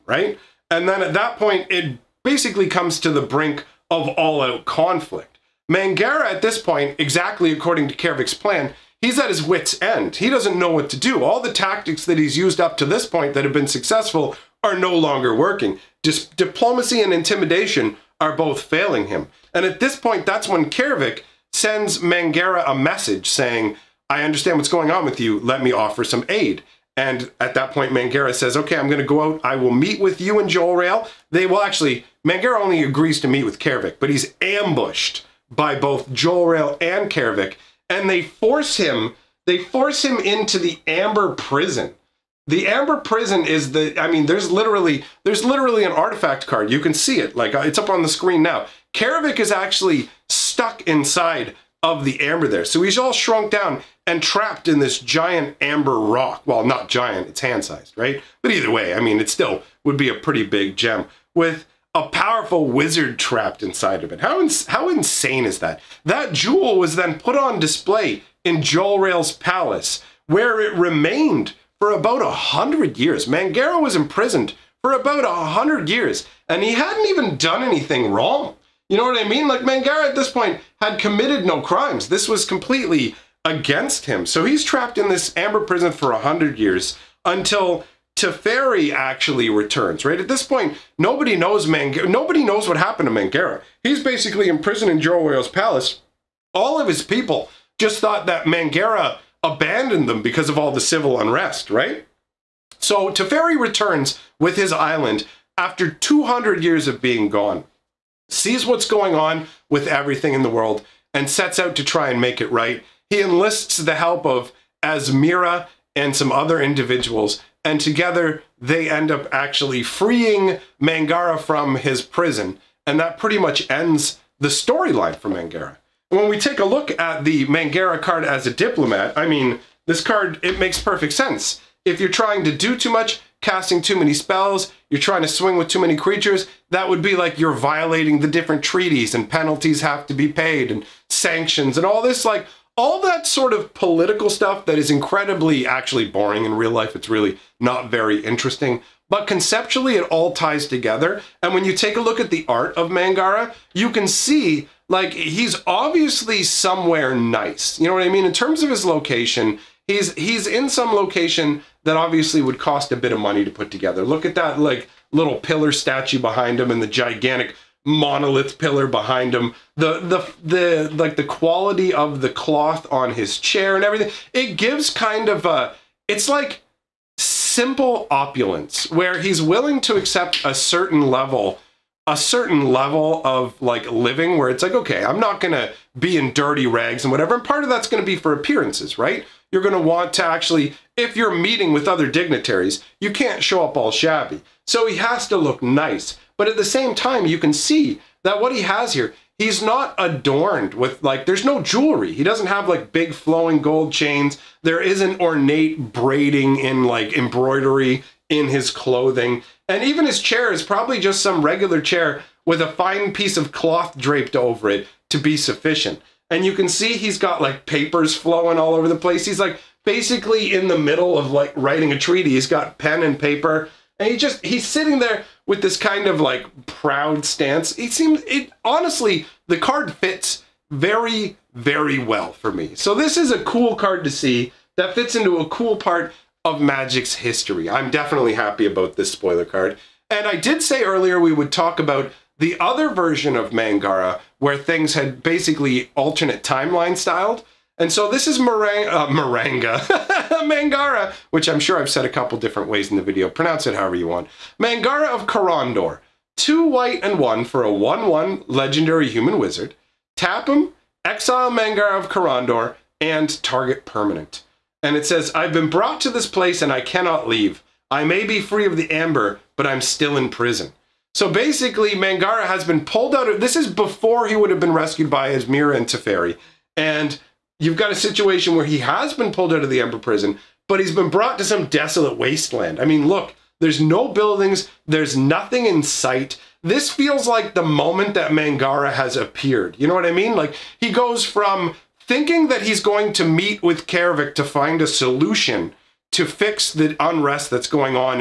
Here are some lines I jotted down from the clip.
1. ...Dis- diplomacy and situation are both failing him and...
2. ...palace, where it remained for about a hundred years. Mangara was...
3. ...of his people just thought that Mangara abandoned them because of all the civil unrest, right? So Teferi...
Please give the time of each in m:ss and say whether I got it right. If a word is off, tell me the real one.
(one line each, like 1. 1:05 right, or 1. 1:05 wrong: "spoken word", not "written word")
1. 0:16 wrong: "intimidation", not "situation"
2. 1:09 right
3. 1:36 right.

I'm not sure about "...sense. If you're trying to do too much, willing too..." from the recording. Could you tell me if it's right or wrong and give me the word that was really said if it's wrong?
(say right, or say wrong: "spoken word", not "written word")
wrong: "casting", not "willing".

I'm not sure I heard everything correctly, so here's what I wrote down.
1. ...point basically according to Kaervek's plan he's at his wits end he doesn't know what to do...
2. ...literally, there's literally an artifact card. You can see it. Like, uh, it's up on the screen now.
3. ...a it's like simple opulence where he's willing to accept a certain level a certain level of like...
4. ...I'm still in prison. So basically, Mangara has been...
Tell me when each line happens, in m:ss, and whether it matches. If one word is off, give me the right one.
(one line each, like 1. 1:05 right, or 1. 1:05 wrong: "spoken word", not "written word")
1. 0:06 wrong: "exactly", not "basically"
2. 0:44 right
3. 2:55 right
4. 4:29 right.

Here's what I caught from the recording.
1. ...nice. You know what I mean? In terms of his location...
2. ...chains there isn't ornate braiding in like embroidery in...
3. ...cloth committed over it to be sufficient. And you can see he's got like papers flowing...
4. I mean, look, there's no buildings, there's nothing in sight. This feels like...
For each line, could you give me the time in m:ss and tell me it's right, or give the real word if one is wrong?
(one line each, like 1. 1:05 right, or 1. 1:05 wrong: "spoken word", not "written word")
1. 2:37 right
2. 3:23 right
3. 3:33 wrong: "draped", not "committed"
4. 4:42 right.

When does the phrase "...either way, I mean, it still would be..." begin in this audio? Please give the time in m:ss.
0:58.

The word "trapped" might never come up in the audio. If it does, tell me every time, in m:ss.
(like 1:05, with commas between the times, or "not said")
0:54, 1:03, 1:24.